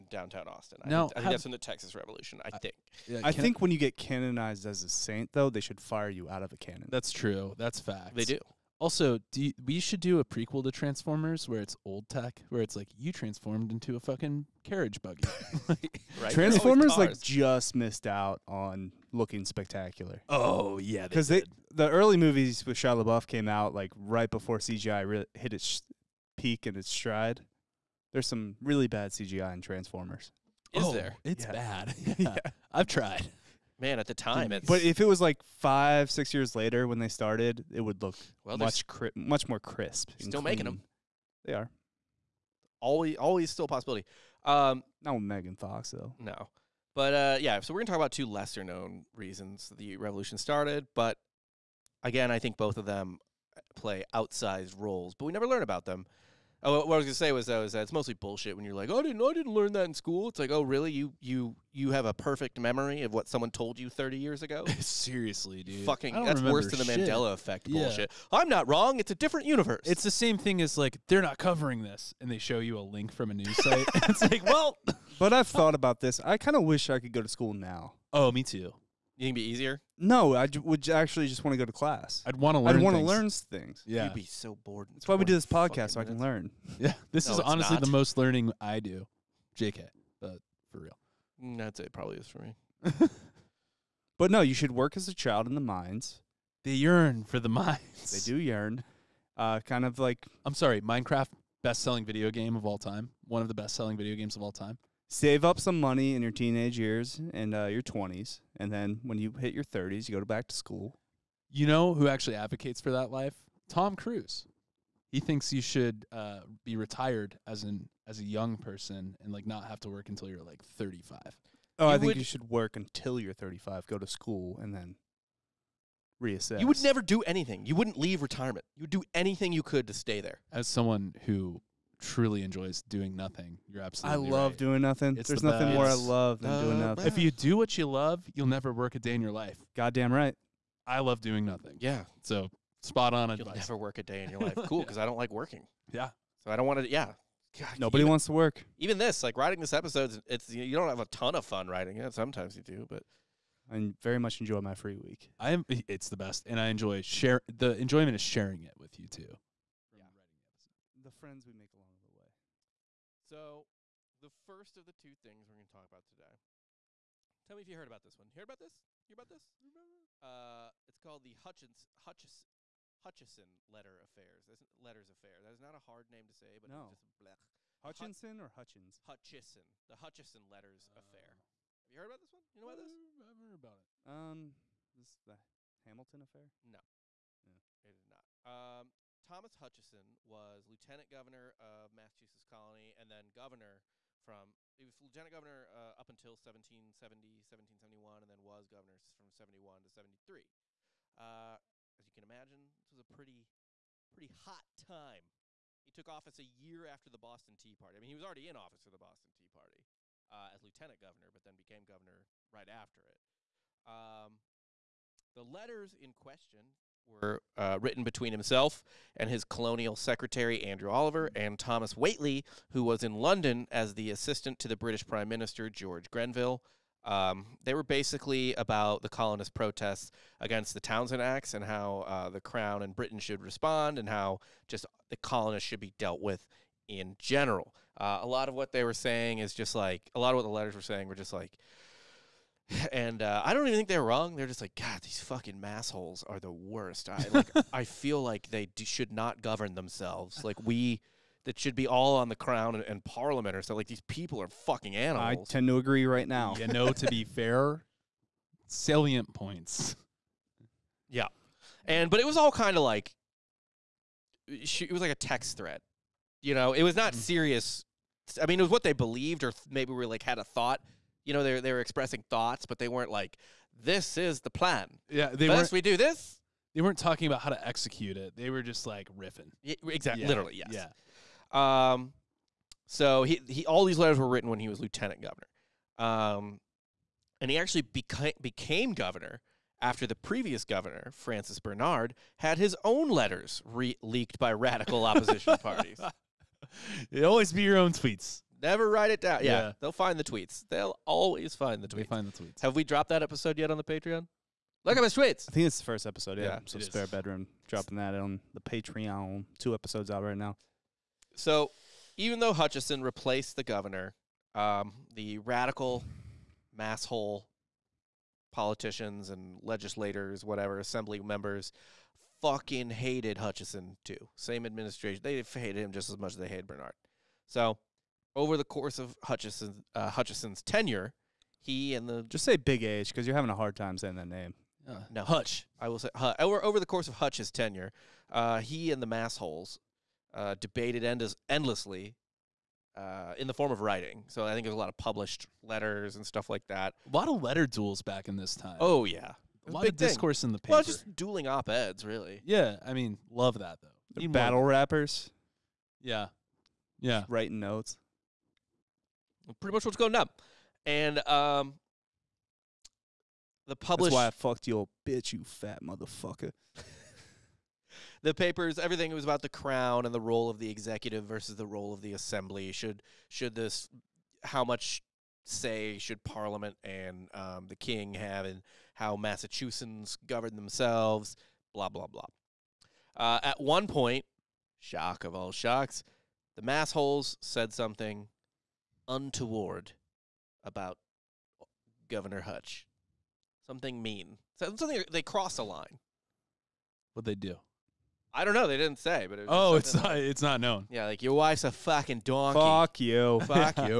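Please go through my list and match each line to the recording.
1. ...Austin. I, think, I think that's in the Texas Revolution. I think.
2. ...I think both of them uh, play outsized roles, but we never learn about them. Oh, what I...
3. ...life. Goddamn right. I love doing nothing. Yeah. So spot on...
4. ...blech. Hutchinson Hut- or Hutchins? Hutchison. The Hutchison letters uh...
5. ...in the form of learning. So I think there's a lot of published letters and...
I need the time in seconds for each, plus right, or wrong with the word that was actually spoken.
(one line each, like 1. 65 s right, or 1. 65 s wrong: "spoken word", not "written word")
1. 0 s right
2. 52 s right
3. 139 s right
4. 177 s right
5. 343 s wrong: "writing", not "learning".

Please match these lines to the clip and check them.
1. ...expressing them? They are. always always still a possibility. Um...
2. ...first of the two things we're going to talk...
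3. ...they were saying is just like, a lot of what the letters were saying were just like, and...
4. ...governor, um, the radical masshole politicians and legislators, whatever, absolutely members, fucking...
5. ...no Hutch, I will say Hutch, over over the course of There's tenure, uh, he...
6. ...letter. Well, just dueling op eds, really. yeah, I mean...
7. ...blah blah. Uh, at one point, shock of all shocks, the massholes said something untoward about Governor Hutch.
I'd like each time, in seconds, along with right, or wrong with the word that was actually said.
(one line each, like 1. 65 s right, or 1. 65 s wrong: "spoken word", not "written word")
1. 40 s wrong: "making", not "expressing"
2. 164 s right
3. 238 s right
4. 313 s wrong: "assembly", not "absolutely"
5. 335 s wrong: "Hutch", not "There"
6. 350 s wrong: "paper", not "letter"
7. 381 s right.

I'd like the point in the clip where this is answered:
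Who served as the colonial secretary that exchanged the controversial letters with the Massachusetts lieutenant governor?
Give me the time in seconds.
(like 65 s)
220 s.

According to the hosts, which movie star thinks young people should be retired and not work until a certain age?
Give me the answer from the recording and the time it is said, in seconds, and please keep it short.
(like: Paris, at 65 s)
Tom Cruise, at 113 s.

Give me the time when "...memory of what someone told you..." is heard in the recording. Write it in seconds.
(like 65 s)
62 s.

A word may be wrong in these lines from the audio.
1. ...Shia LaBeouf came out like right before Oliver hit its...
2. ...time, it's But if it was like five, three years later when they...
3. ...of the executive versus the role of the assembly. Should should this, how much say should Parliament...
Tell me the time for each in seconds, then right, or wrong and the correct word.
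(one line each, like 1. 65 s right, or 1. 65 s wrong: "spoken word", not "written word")
1. 22 s wrong: "CGI", not "Oliver"
2. 34 s wrong: "six", not "three"
3. 370 s right.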